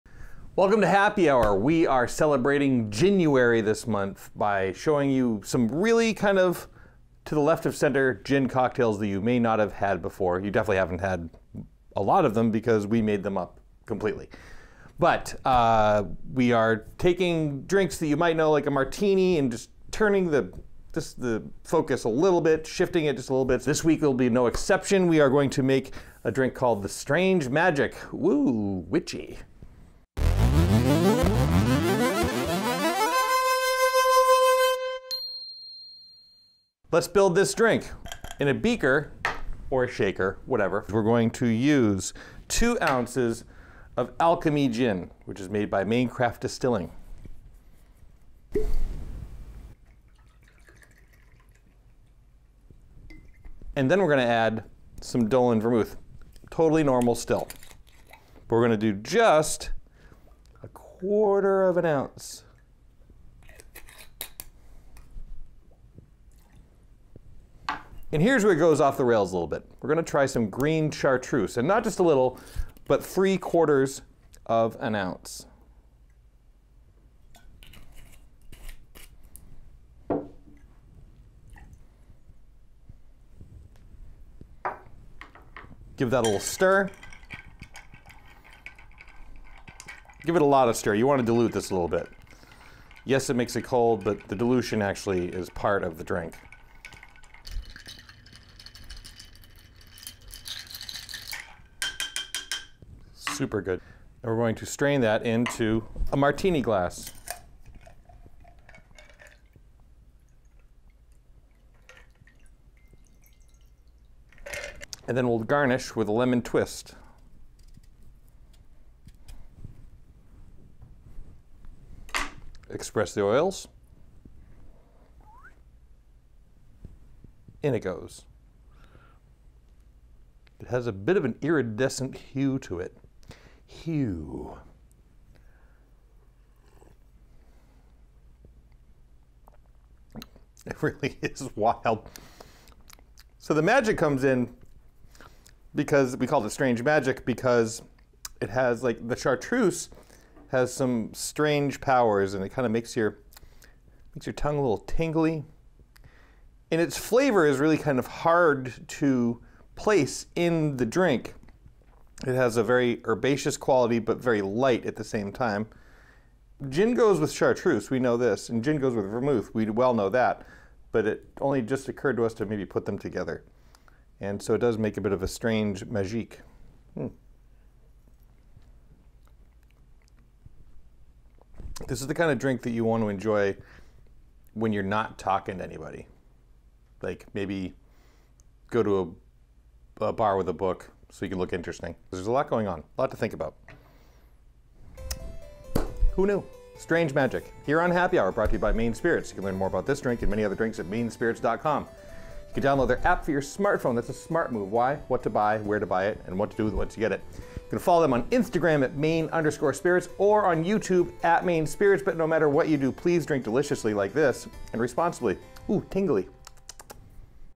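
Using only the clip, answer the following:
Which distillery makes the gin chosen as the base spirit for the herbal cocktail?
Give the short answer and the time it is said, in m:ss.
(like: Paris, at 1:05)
Maine Craft Distilling, at 0:45.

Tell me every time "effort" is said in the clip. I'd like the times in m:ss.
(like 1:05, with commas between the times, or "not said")
not said.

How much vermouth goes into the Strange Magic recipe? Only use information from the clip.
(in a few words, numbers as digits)
1/4 ounce.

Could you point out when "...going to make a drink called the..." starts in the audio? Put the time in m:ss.
0:25.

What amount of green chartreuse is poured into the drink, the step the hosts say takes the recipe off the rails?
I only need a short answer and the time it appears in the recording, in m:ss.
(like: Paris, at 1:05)
3/4 ounce, at 1:13.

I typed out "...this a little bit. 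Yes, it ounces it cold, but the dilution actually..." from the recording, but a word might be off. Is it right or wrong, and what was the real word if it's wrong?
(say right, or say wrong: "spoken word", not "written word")
wrong: "makes", not "ounces".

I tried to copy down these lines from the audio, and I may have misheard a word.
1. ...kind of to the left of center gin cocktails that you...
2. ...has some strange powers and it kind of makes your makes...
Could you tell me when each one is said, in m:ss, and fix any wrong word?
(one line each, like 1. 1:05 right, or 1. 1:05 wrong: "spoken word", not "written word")
1. 0:06 right
2. 2:30 right.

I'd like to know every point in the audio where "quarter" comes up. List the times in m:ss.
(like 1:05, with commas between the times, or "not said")
1:00, 1:13.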